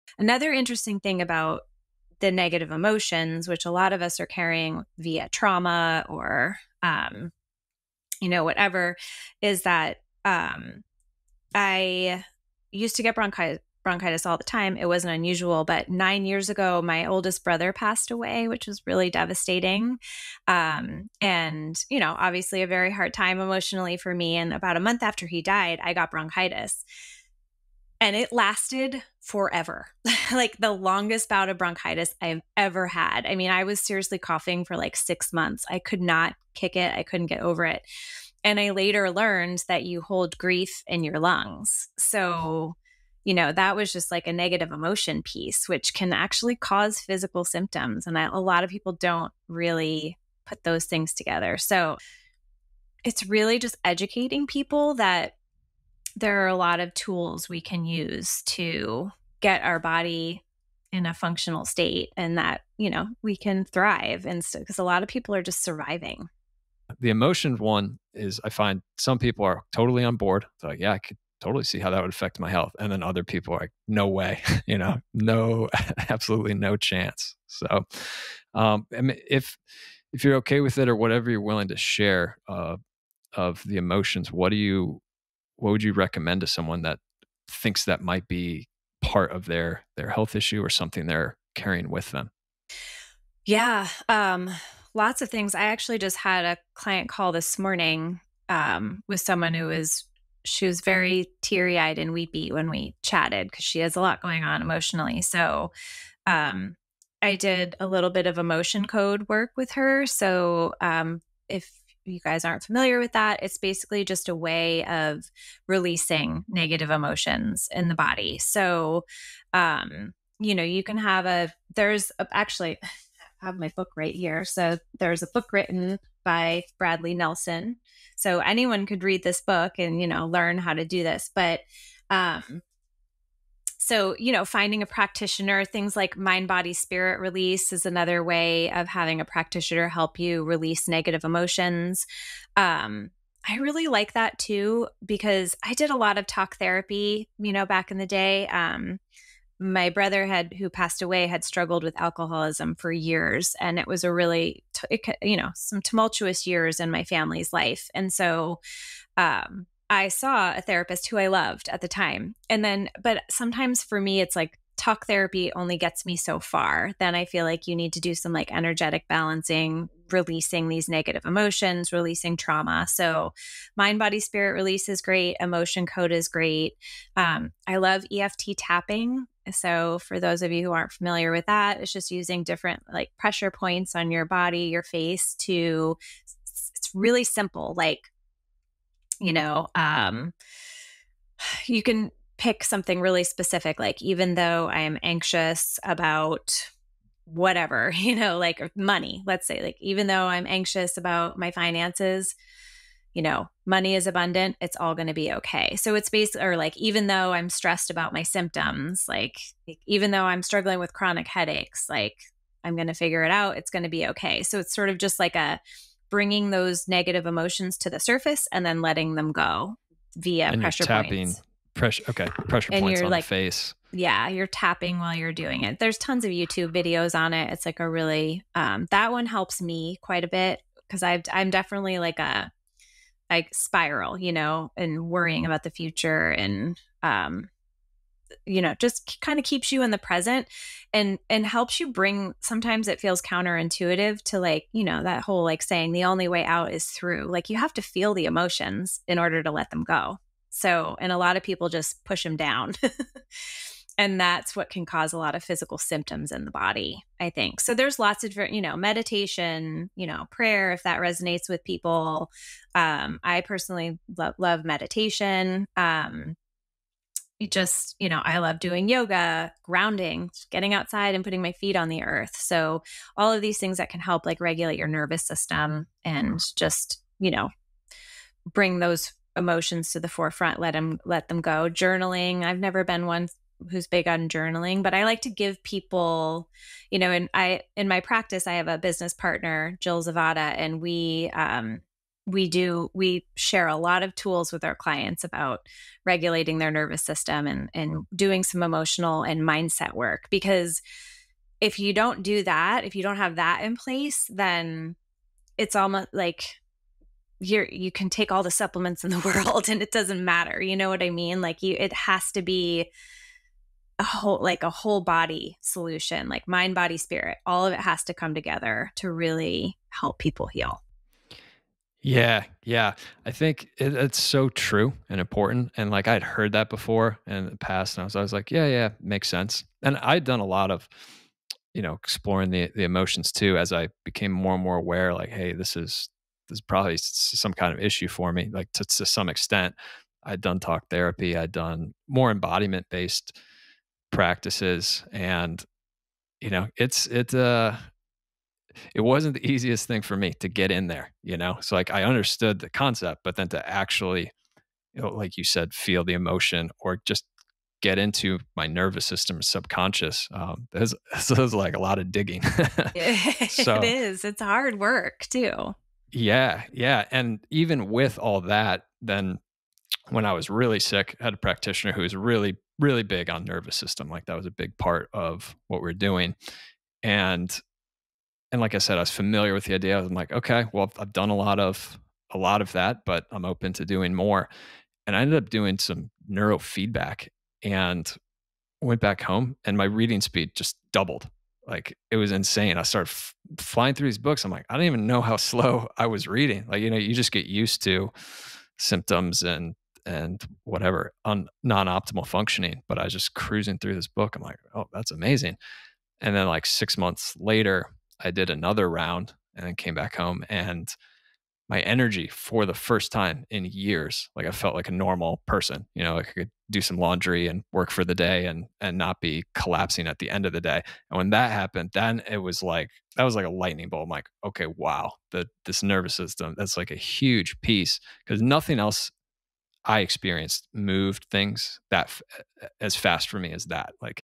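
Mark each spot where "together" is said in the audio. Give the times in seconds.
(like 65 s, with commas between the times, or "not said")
51 s, 318 s.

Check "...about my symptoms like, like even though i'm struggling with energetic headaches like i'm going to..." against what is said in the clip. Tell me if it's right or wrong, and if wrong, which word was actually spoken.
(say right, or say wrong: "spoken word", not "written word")
wrong: "chronic", not "energetic".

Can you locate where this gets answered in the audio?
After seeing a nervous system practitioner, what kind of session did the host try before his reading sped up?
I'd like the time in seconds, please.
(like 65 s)
386 s.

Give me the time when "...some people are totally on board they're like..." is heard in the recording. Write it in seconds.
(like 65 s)
68 s.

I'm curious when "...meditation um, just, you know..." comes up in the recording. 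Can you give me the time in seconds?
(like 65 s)
264 s.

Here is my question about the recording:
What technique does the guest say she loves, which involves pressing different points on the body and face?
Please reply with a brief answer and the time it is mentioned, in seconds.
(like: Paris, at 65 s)
EFT tapping, at 178 s.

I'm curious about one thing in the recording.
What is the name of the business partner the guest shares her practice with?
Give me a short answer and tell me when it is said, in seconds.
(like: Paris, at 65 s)
Jill Zavada, at 289 s.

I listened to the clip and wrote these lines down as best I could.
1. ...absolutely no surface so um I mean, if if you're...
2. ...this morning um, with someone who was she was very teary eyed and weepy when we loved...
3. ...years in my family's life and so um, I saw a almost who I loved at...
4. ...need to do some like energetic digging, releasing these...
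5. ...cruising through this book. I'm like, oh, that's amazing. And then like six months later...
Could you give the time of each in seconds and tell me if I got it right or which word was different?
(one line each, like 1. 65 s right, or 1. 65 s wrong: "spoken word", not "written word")
1. 76 s wrong: "chance", not "surface"
2. 97 s wrong: "chatted", not "loved"
3. 156 s wrong: "therapist", not "almost"
4. 167 s wrong: "balancing", not "digging"
5. 403 s right.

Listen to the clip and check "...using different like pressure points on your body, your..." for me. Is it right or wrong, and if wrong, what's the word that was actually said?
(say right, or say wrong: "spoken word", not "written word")
right.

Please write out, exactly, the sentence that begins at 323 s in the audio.
I think it, it's so true and important.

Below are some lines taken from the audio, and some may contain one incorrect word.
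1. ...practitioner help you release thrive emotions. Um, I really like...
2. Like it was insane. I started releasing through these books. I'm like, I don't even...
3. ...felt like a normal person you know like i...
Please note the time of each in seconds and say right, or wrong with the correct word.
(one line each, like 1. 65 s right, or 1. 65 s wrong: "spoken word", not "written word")
1. 139 s wrong: "negative", not "thrive"
2. 391 s wrong: "flying", not "releasing"
3. 414 s right.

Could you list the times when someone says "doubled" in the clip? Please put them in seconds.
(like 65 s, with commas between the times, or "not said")
390 s.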